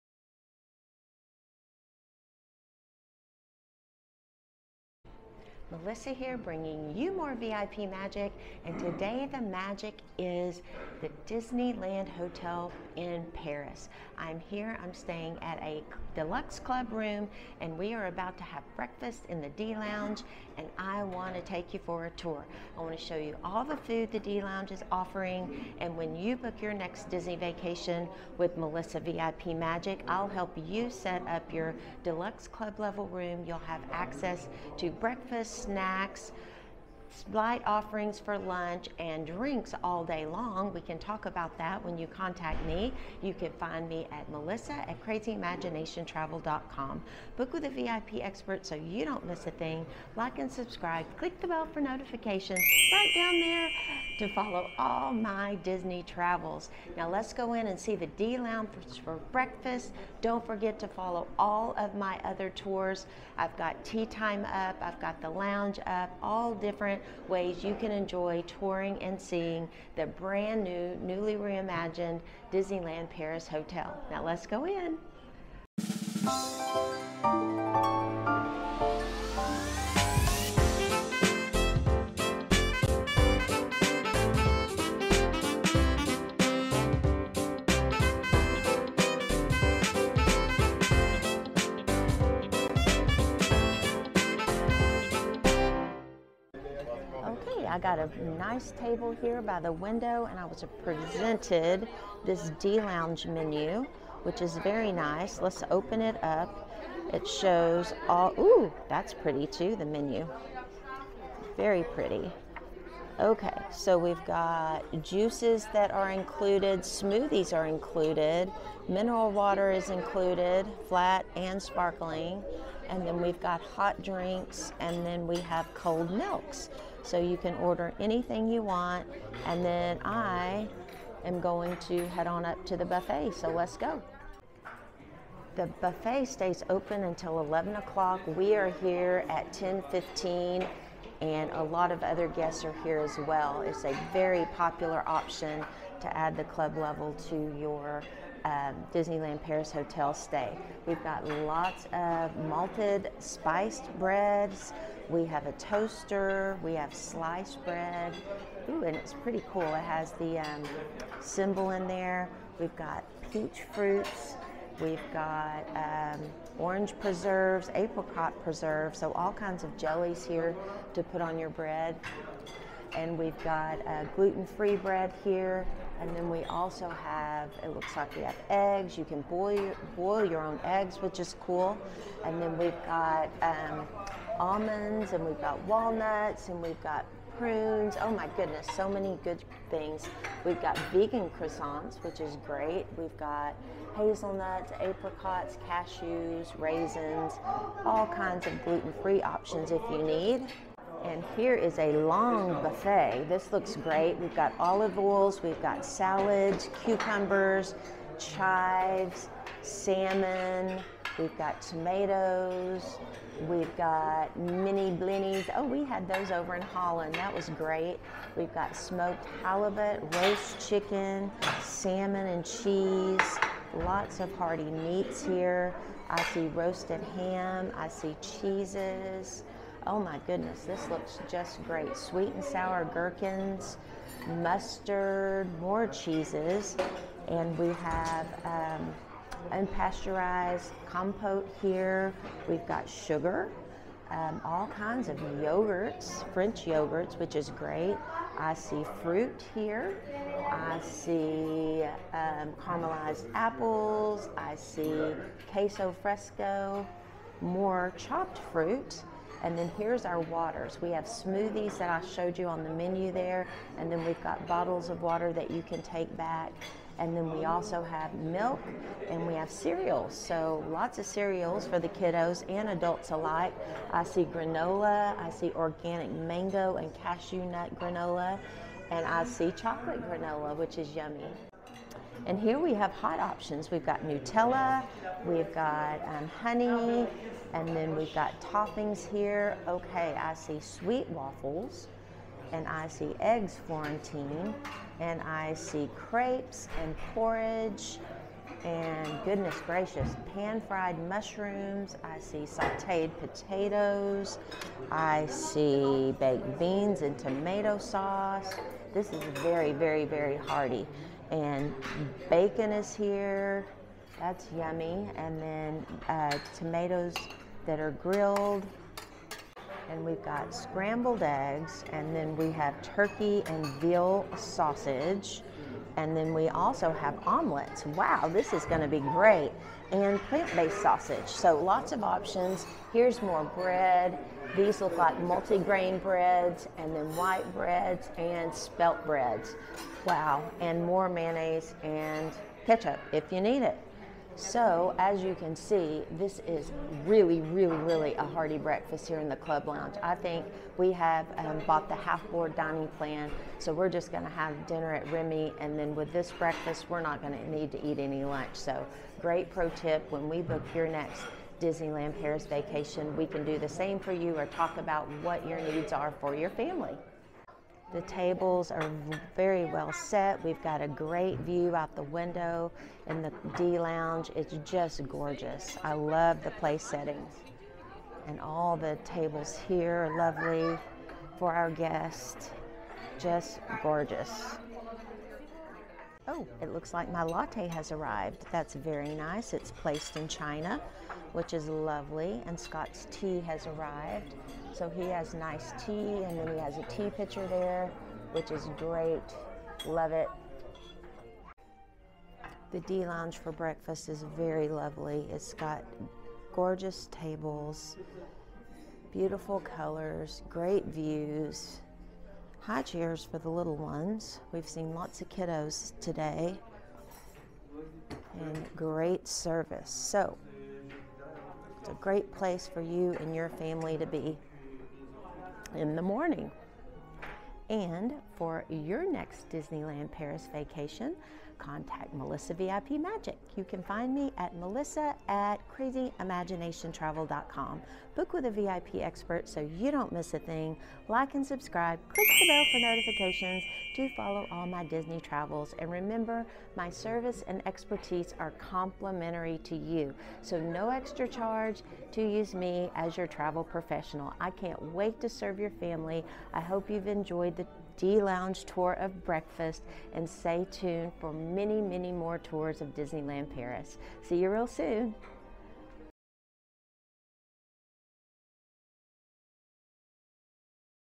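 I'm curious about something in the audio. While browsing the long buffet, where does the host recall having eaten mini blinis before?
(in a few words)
Holland.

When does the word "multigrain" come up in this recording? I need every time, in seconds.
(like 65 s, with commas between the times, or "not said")
335 s.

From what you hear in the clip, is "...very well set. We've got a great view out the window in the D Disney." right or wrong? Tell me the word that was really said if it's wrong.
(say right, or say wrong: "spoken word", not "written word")
wrong: "Lounge", not "Disney".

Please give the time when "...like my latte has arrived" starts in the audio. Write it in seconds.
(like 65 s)
386 s.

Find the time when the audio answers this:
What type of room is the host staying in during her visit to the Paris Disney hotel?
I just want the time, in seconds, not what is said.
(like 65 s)
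16 s.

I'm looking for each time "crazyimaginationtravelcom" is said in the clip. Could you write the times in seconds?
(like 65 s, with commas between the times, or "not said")
45 s, 435 s.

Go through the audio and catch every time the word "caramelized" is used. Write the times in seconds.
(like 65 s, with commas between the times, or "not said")
252 s.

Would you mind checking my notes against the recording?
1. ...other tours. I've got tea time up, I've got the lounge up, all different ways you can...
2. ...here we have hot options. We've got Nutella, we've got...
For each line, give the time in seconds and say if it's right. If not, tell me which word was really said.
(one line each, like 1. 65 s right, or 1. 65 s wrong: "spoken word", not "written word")
1. 62 s right
2. 282 s right.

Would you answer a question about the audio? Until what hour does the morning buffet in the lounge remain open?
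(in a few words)
11 o'clock.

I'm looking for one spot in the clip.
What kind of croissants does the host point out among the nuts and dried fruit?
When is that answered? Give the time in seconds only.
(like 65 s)
190 s.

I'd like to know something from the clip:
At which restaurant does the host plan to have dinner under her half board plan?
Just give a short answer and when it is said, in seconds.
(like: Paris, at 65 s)
Remy, at 355 s.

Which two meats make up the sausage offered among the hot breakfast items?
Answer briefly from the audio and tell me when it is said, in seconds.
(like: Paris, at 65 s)
Turkey and veal, at 322 s.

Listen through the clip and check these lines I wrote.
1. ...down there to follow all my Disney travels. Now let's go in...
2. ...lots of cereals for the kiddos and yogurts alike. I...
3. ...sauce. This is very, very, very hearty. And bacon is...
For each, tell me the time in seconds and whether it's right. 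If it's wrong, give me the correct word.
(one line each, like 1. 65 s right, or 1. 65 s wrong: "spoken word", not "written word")
1. 53 s right
2. 270 s wrong: "adults", not "yogurts"
3. 307 s right.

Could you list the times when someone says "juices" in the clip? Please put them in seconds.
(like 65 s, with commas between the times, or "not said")
115 s.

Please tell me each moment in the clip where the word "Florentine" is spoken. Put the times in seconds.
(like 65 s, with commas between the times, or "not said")
293 s.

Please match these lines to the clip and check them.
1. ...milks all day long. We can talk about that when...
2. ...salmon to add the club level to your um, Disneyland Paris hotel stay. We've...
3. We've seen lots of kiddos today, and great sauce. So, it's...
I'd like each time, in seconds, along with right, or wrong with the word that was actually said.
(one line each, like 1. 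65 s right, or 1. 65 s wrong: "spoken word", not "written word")
1. 39 s wrong: "drinks", not "milks"
2. 145 s wrong: "option", not "salmon"
3. 414 s wrong: "service", not "sauce".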